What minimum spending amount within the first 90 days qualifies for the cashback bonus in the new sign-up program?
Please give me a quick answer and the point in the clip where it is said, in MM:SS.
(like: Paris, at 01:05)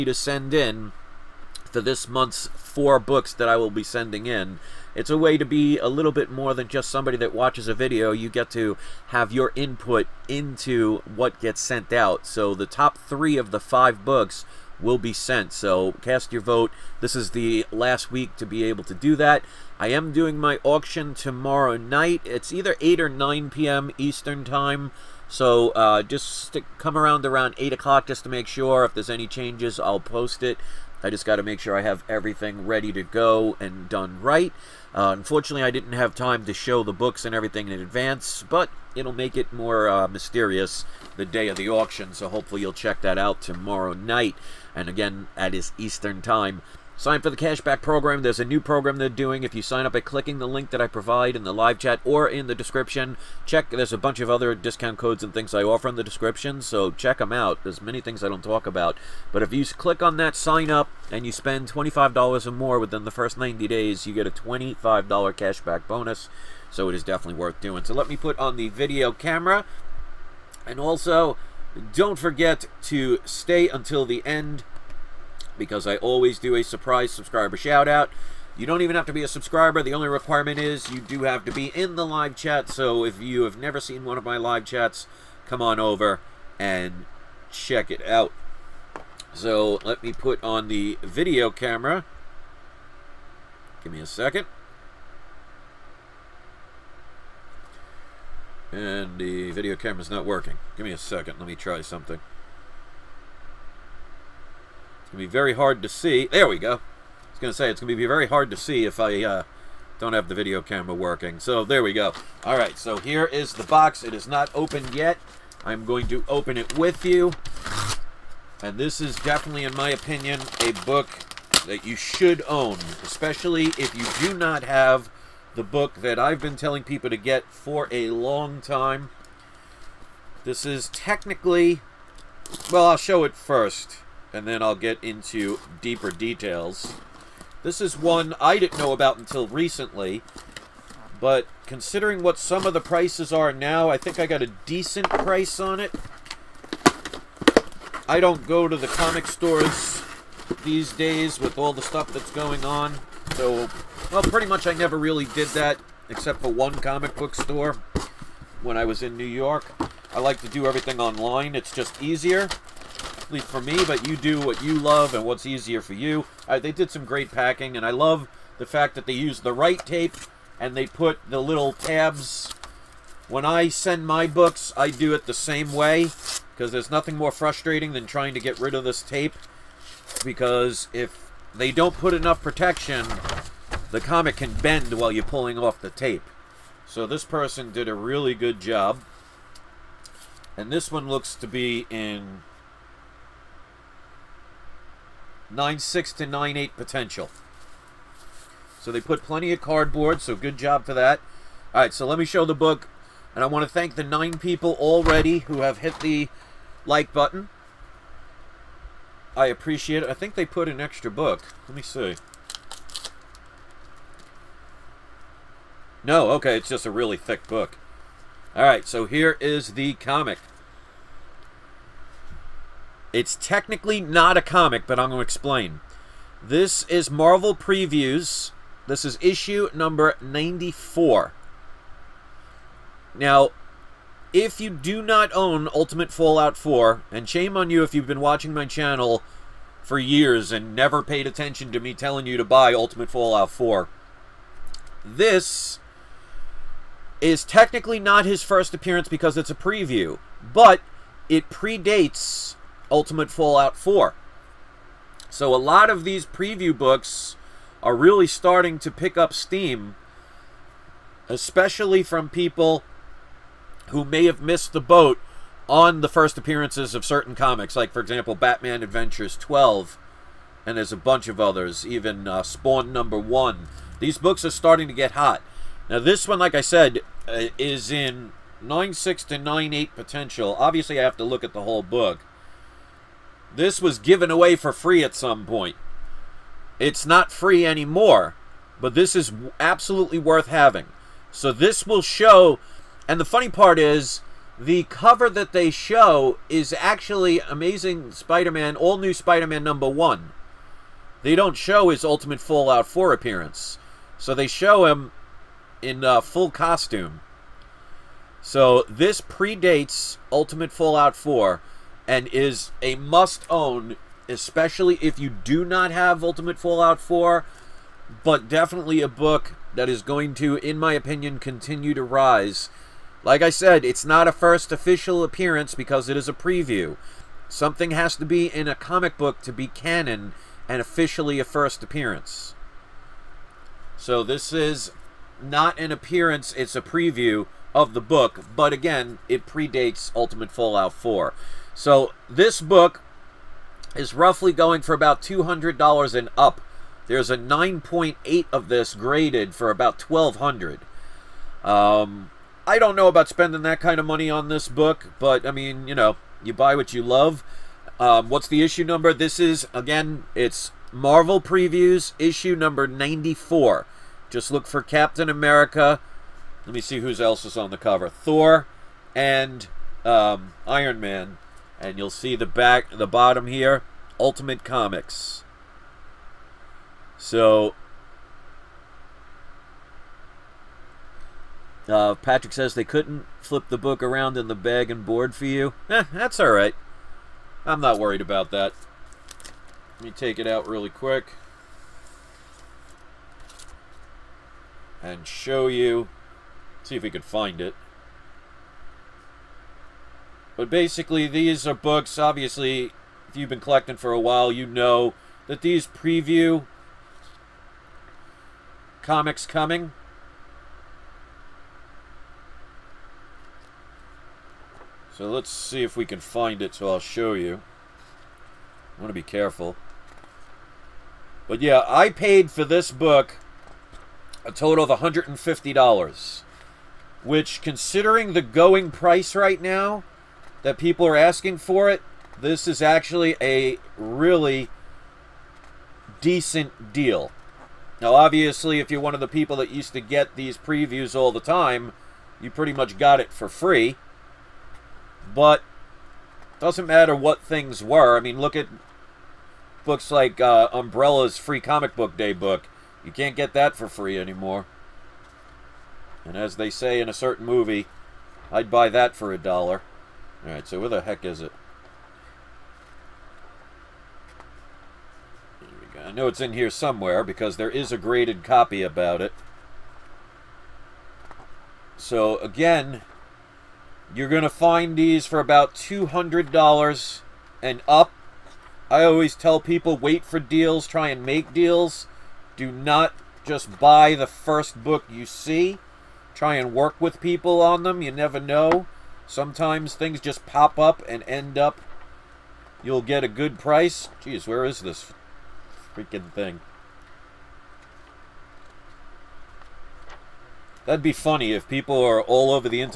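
$25, at 01:01.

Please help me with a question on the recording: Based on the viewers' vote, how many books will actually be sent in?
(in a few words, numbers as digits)
3.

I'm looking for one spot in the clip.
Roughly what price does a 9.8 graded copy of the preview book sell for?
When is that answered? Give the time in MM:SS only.
05:49.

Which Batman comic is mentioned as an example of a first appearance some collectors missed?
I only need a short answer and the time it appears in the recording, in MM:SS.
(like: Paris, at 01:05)
Batman Adventures 12, at 04:28.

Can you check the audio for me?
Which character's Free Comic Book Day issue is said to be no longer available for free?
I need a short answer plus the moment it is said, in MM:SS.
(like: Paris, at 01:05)
Umbrella's, at 07:30.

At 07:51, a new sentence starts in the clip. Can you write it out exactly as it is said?
So again, you're going to find these for about $200 and up.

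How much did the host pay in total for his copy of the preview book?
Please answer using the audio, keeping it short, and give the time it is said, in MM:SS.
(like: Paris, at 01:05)
$150, at 07:04.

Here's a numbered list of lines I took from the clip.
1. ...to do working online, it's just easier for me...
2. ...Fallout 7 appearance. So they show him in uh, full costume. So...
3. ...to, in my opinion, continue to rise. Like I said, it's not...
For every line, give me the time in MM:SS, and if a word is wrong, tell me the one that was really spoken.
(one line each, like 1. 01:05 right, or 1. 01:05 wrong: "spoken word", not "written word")
1. 02:40 wrong: "everything", not "working"
2. 05:02 wrong: "4", not "7"
3. 05:20 right.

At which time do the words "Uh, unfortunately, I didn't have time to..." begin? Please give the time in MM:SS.
00:34.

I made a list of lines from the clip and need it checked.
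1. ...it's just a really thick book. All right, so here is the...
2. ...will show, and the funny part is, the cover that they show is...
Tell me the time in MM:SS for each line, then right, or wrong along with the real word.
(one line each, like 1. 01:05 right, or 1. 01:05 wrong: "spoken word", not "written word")
1. 03:36 right
2. 04:51 right.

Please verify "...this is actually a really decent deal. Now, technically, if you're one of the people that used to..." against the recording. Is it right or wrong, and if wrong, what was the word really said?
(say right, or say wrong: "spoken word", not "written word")
wrong: "obviously", not "technically".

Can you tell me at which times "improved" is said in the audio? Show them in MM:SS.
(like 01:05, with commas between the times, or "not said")
not said.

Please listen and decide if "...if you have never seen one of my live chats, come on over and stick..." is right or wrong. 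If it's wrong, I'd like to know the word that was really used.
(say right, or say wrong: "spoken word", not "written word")
wrong: "check", not "stick".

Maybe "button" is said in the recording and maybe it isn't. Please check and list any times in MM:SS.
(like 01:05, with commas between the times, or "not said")
03:27.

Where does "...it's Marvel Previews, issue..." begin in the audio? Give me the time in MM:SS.
06:00.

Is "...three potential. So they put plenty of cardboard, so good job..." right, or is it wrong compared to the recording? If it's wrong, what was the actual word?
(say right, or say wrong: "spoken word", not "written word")
wrong: "eight", not "three".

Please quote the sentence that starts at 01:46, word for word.
I was going to say, it's going to be very hard to see if I uh, don't have the video camera working.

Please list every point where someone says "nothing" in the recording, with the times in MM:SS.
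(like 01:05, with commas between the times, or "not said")
02:56.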